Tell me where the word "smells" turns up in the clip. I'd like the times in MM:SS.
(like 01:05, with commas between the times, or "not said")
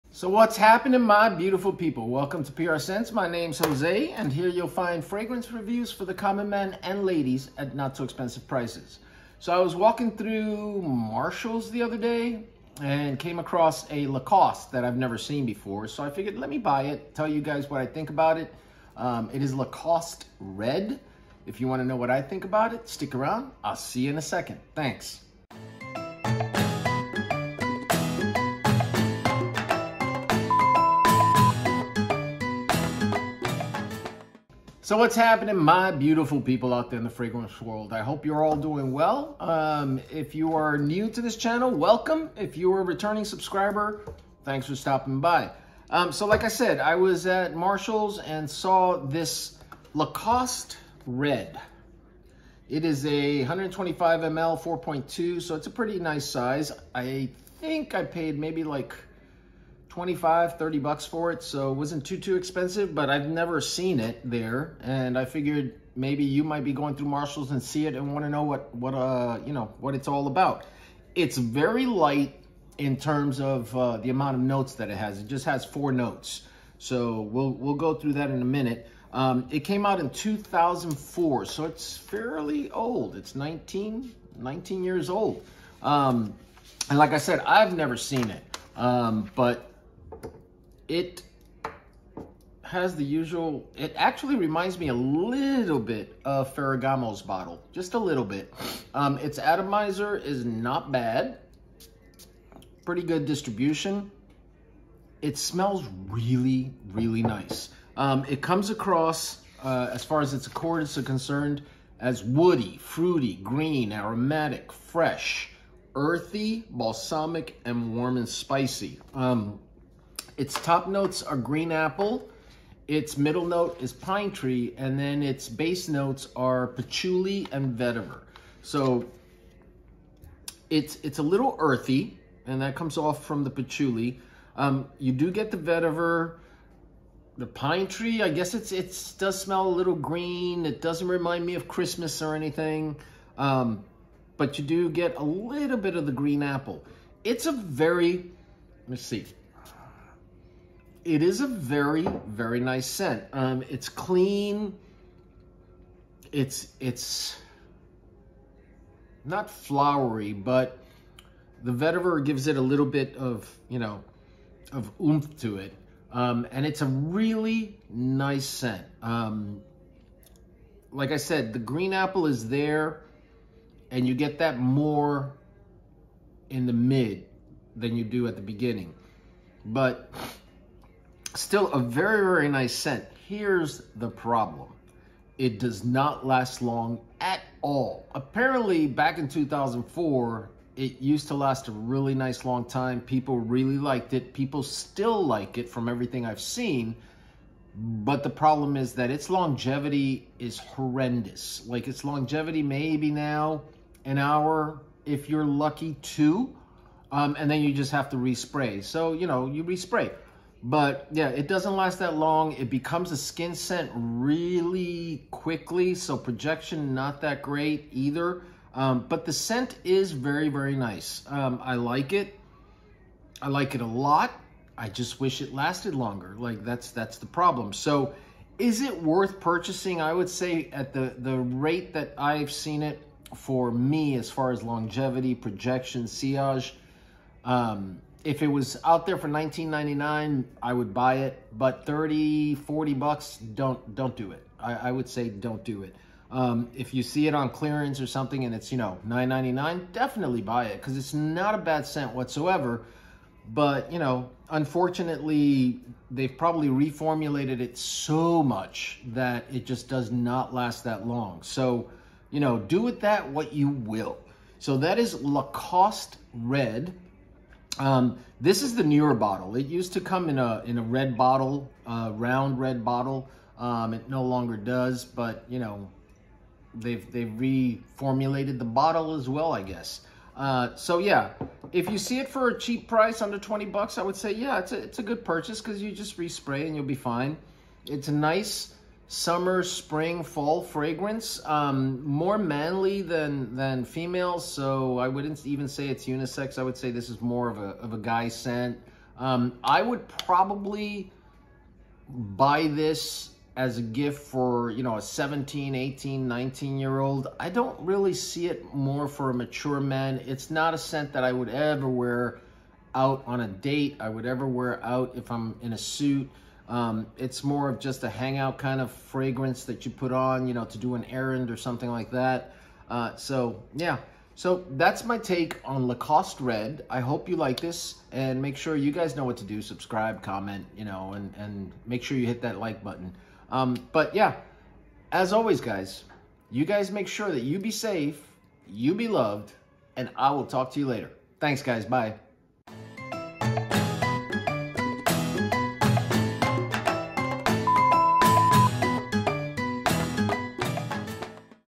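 01:45, 02:19.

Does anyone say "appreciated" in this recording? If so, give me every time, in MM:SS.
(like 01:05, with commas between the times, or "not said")
not said.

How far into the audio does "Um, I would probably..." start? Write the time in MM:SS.
04:59.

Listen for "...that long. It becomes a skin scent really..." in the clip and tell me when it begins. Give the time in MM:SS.
03:31.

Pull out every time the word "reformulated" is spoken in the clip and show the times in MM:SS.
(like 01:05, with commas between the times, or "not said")
04:16, 04:37.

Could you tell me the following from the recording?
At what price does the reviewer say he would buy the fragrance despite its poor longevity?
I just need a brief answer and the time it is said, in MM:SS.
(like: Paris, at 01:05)
$19.99, at 03:59.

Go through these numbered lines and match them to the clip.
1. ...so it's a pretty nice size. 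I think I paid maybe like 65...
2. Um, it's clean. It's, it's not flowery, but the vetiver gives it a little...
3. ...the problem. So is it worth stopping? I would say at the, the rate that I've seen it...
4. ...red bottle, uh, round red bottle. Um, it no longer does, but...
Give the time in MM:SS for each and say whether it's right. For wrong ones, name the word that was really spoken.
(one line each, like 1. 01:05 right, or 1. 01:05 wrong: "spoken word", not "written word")
1. 00:55 wrong: "25", not "65"
2. 02:33 right
3. 03:47 wrong: "purchasing", not "stopping"
4. 04:30 right.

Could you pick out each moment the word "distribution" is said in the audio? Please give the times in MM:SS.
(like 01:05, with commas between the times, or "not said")
01:43.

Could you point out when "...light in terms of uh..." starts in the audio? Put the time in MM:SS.
01:11.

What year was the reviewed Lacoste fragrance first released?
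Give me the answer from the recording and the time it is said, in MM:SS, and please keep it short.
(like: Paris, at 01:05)
2004, at 01:19.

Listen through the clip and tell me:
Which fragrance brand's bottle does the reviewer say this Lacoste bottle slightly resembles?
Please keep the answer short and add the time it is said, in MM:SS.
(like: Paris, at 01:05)
Ferragamo, at 01:36.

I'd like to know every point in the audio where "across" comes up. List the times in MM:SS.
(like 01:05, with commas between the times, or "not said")
00:13, 01:48.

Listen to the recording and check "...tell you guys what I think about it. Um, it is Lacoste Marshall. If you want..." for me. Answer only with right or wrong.
wrong.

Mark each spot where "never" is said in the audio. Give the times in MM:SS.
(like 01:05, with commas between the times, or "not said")
00:14, 01:03, 01:27.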